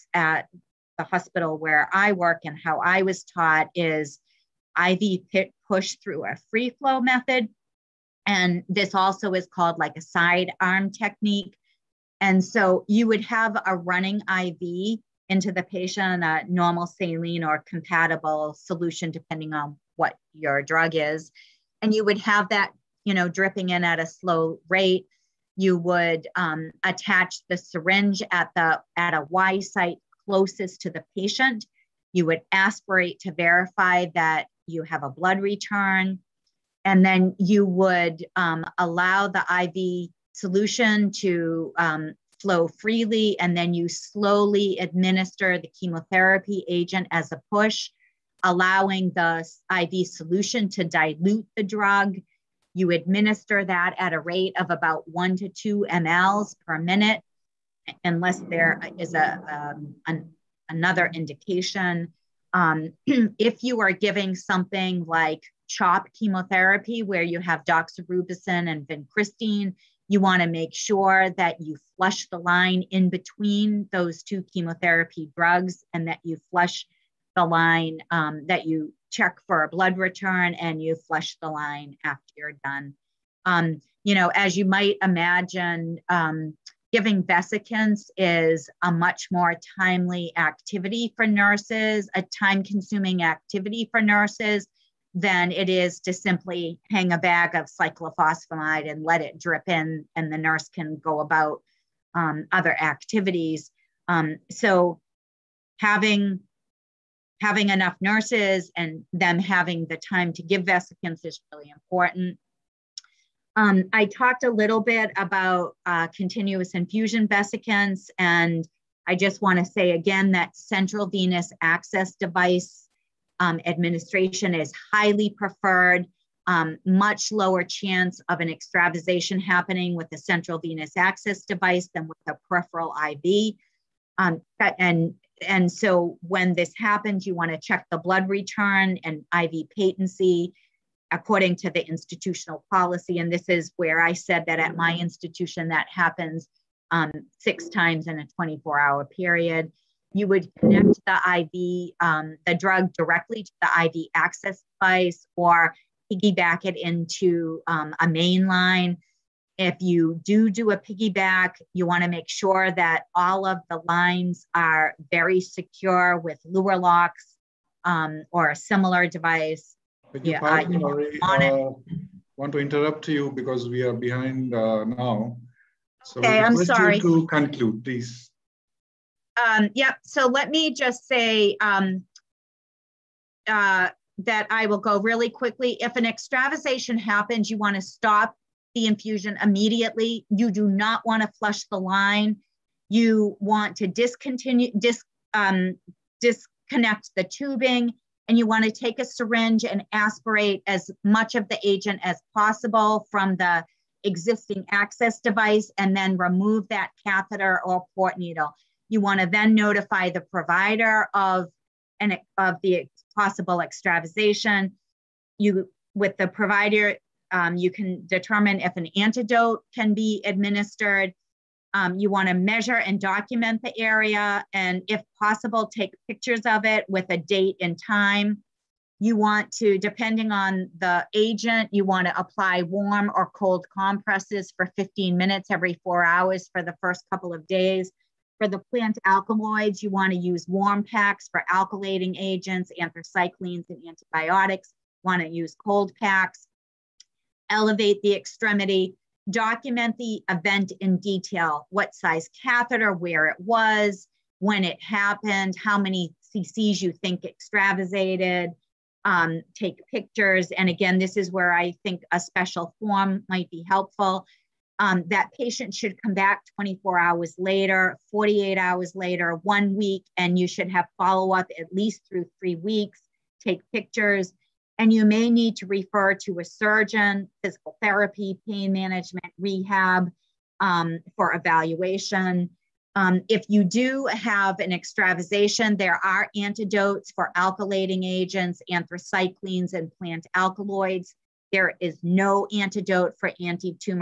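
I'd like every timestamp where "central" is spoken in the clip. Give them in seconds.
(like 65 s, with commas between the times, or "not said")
120 s, 130 s.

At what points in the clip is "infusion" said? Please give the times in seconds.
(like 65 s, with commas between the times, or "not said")
116 s, 188 s.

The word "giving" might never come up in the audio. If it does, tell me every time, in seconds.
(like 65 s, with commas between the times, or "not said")
63 s, 86 s.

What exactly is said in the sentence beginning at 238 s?
For the plant alkaloids, you want to use warm packs for alkylating agents, anthracyclines, and antibiotics.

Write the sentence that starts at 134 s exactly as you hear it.
Um, and, and so when this happens, you want to check the blood return and IV patency according to the institutional policy.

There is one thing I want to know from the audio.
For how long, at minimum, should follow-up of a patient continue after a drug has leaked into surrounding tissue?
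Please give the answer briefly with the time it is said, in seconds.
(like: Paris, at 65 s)
3 weeks, at 272 s.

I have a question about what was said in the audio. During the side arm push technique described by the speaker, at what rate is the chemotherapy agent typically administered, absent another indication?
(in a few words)
1 to 2 mL per minute.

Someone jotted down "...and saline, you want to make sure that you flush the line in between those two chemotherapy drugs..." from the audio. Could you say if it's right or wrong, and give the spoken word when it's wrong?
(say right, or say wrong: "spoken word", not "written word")
wrong: "vincristine", not "saline".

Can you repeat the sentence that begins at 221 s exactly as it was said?
Um, you want to measure and document the area, and if possible, take pictures of it with a date and time.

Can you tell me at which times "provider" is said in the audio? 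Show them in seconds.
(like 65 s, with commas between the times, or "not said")
210 s, 216 s.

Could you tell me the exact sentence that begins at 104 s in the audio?
Um, so having having enough nurses and them having the time to give vesicants is really important.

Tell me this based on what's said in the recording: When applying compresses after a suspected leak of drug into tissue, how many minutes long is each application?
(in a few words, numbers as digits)
15 minutes.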